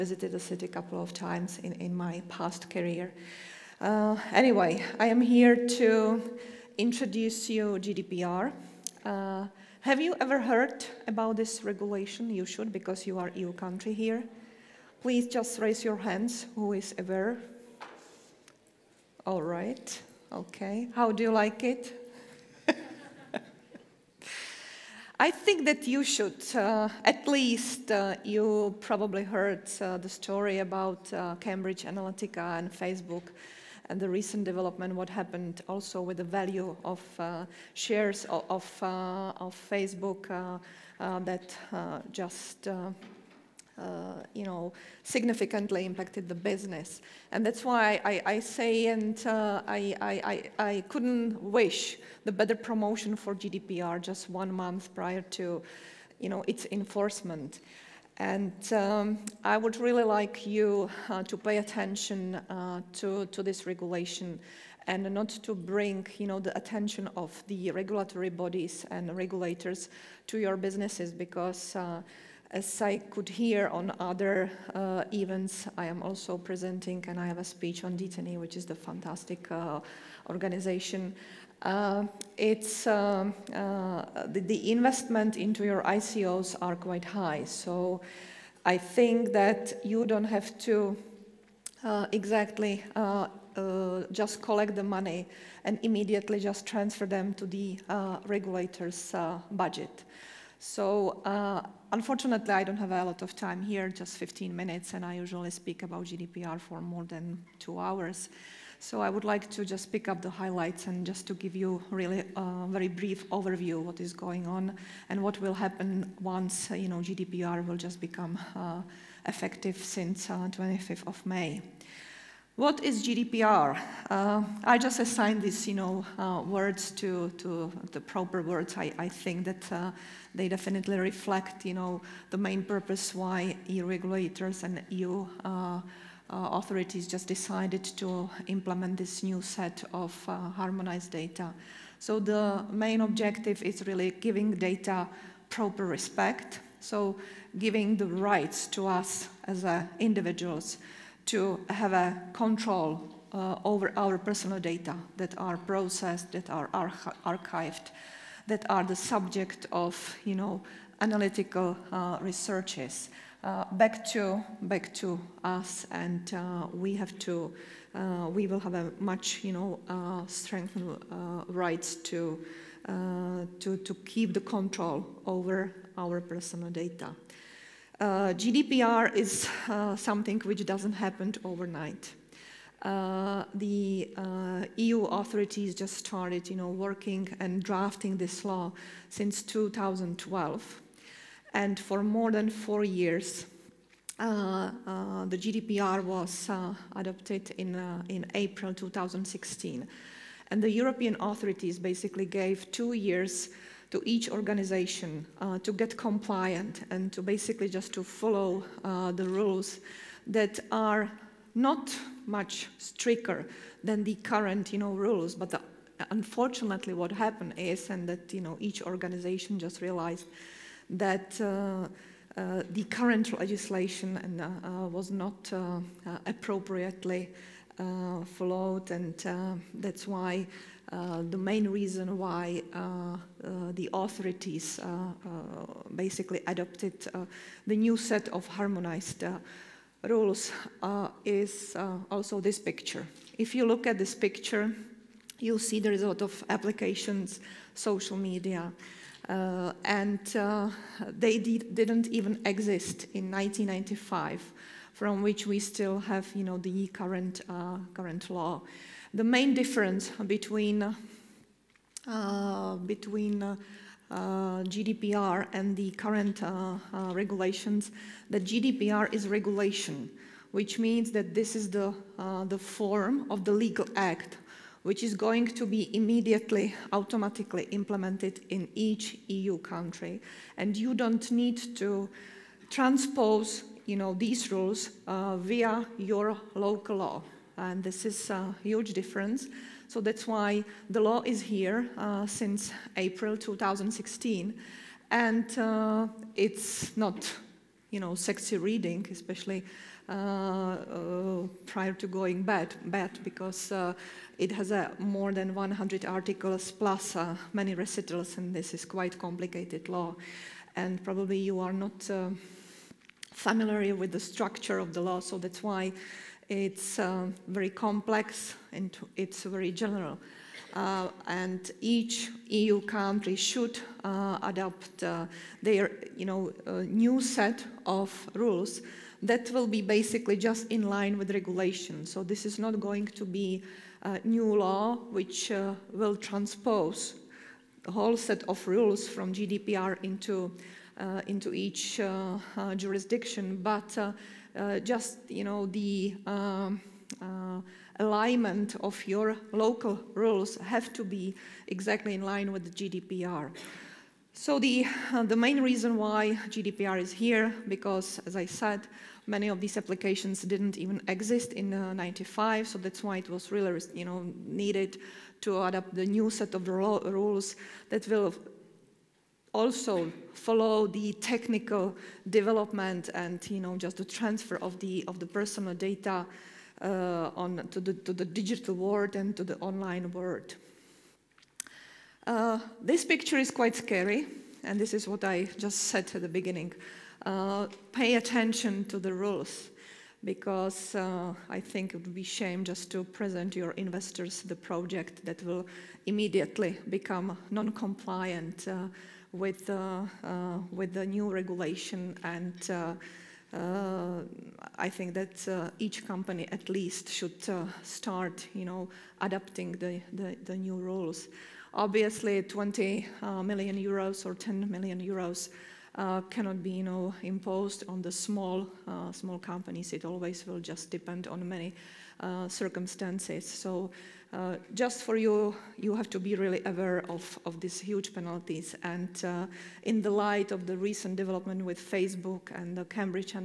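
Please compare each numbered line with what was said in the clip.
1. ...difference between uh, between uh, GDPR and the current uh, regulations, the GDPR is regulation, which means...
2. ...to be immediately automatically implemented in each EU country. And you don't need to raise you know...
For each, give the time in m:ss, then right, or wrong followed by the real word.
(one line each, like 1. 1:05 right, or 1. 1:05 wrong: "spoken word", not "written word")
1. 4:19 right
2. 4:35 wrong: "transpose", not "raise".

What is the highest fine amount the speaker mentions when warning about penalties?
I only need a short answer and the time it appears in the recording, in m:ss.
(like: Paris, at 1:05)
20 million euros, at 6:52.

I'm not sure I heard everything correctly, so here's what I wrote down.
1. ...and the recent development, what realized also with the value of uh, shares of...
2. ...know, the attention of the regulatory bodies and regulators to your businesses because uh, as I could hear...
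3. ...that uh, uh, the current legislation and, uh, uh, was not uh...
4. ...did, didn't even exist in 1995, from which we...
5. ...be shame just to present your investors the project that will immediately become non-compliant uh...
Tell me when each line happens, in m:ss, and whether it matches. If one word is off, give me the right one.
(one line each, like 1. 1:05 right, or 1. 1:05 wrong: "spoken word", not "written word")
1. 0:33 wrong: "happened", not "realized"
2. 1:06 right
3. 3:40 right
4. 4:11 right
5. 6:32 right.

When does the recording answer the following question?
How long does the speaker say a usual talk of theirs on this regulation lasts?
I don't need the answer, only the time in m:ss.
1:46.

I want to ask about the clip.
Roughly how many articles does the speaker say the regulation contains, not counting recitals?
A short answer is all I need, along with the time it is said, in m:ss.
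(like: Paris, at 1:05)
more than 100, at 5:05.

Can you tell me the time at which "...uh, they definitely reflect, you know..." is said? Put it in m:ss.
2:09.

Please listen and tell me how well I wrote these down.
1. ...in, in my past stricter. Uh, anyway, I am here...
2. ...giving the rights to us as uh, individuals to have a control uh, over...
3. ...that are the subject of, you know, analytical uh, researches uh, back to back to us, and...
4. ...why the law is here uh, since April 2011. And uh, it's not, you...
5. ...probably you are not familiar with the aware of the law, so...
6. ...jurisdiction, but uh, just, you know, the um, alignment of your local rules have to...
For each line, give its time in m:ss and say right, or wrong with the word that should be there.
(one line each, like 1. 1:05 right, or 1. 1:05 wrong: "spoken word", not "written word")
1. 0:01 wrong: "career", not "stricter"
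2. 2:27 right
3. 2:38 right
4. 4:50 wrong: "2016", not "2011"
5. 5:11 wrong: "structure", not "aware"
6. 5:42 right.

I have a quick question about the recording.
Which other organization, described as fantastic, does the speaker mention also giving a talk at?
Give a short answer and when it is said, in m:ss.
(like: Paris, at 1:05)
d10e, at 1:17.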